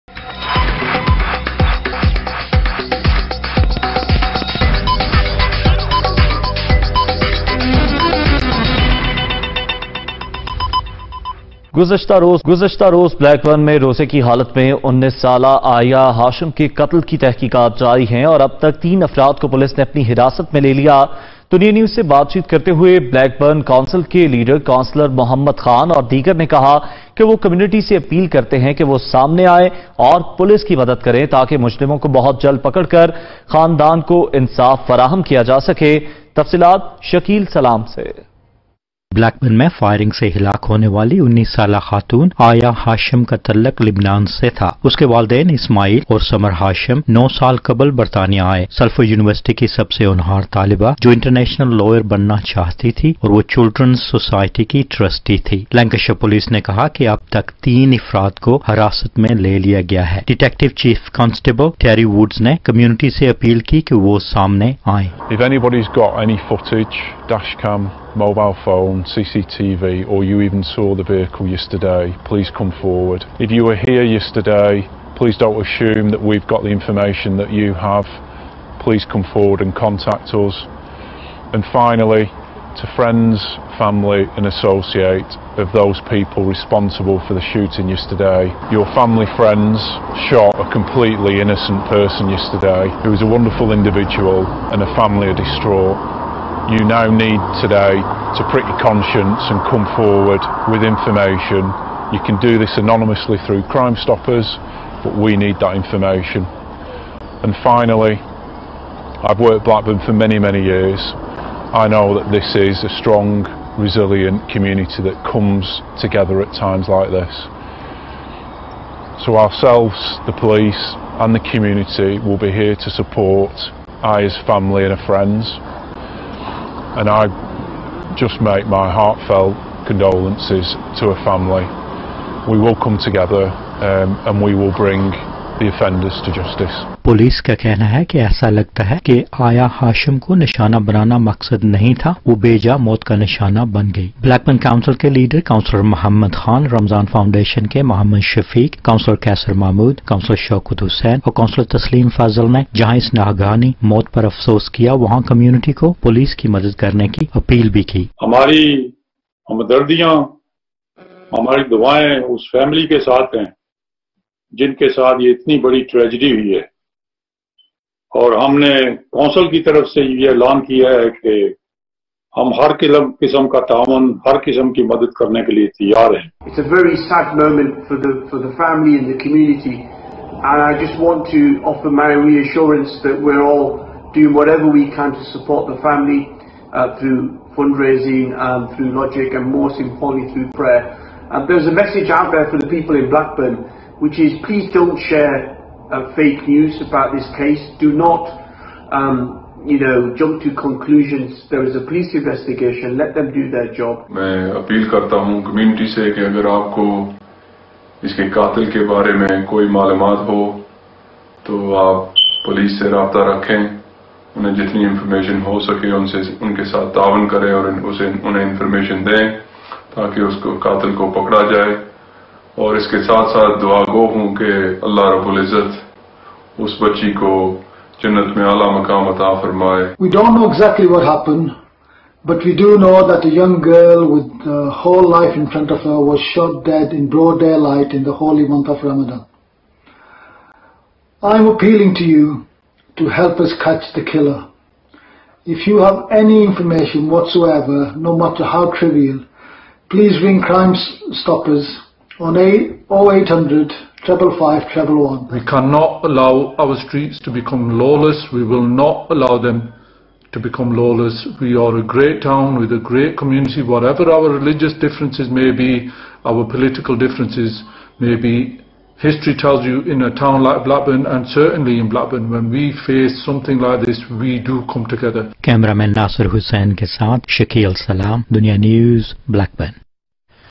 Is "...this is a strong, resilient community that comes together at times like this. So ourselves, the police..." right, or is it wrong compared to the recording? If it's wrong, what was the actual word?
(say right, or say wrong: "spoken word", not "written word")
right.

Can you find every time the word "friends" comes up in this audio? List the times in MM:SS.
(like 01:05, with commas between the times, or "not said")
01:22, 01:29, 02:05.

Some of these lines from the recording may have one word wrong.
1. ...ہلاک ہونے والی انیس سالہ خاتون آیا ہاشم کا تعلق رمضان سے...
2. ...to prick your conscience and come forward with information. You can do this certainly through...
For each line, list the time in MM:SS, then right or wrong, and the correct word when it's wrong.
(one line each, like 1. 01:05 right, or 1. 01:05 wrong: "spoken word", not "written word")
1. 00:40 wrong: "لبنان", not "رمضان"
2. 01:38 wrong: "anonymously", not "certainly".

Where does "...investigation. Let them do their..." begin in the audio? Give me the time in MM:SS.
03:22.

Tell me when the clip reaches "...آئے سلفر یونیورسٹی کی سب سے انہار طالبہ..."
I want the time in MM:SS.
00:48.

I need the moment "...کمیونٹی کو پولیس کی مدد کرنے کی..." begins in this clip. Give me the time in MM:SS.
02:35.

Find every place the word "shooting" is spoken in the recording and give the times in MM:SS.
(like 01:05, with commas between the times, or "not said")
01:27.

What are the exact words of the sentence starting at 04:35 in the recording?
Cameraman Nasser Hussain ke Shakil Salam, Dunya News, Blackburn.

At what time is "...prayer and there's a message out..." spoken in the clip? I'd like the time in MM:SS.
03:10.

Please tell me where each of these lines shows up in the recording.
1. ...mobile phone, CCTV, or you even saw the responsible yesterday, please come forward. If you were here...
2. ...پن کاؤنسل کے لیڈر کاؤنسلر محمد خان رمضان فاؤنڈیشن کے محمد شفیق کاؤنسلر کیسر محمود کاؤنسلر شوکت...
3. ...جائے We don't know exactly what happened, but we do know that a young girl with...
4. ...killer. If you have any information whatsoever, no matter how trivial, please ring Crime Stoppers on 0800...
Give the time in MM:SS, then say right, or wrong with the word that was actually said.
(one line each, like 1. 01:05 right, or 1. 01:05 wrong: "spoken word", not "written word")
1. 01:08 wrong: "vehicle", not "responsible"
2. 02:24 right
3. 03:41 right
4. 04:04 right.